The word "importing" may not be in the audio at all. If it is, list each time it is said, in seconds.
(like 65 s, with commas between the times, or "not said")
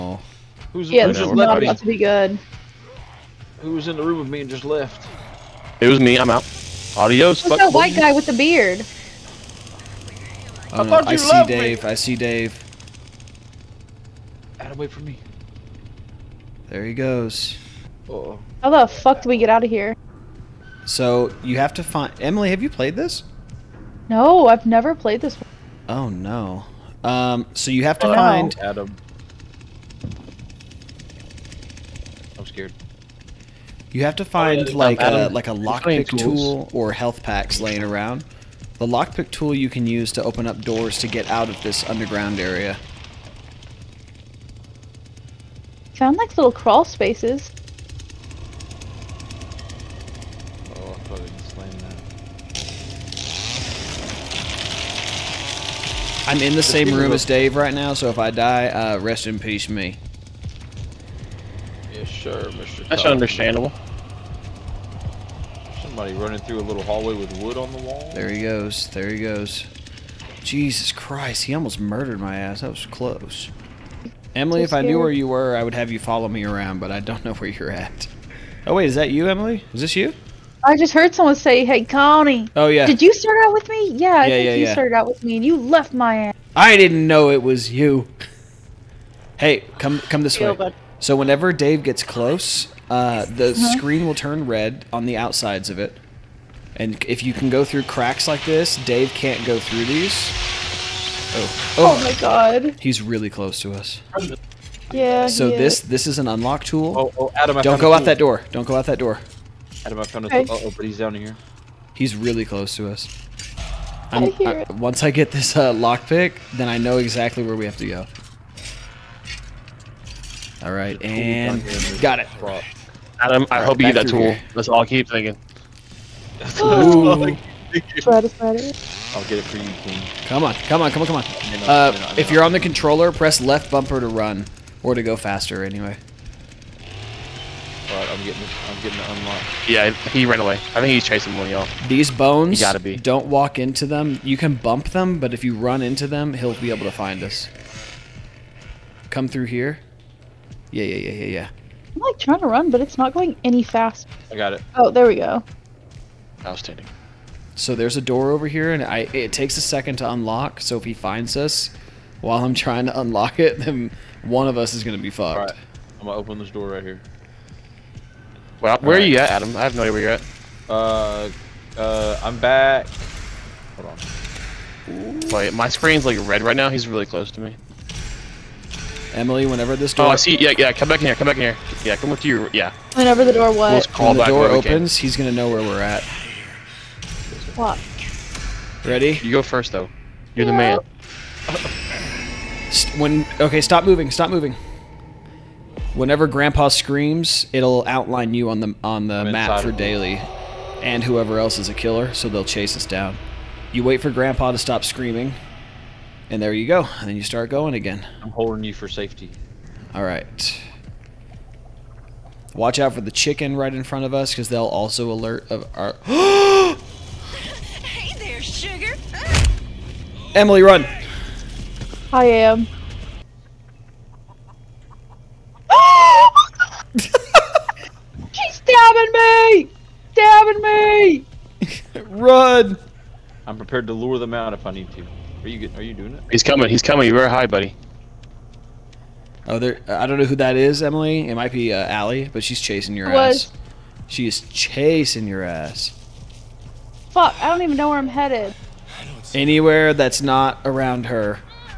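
not said.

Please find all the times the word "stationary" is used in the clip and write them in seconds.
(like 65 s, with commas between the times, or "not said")
not said.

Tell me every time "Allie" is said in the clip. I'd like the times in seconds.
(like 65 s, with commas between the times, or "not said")
241 s.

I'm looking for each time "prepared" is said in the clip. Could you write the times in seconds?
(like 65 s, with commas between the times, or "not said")
233 s.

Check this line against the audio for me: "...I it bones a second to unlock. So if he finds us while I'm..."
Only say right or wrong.
wrong.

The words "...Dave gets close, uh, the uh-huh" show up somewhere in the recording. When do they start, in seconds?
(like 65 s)
91 s.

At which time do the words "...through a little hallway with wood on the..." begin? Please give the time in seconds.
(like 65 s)
66 s.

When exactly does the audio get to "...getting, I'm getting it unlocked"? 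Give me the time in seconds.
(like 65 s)
138 s.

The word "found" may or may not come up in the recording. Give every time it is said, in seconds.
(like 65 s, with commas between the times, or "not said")
45 s, 110 s.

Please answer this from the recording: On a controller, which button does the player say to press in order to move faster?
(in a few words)
left bumper.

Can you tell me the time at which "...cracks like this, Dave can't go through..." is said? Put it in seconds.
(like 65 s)
97 s.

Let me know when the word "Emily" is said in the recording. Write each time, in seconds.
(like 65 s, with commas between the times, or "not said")
22 s, 74 s, 79 s, 179 s, 220 s, 240 s.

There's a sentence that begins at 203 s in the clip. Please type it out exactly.
You wait for Grandpa to stop screaming, and there you go.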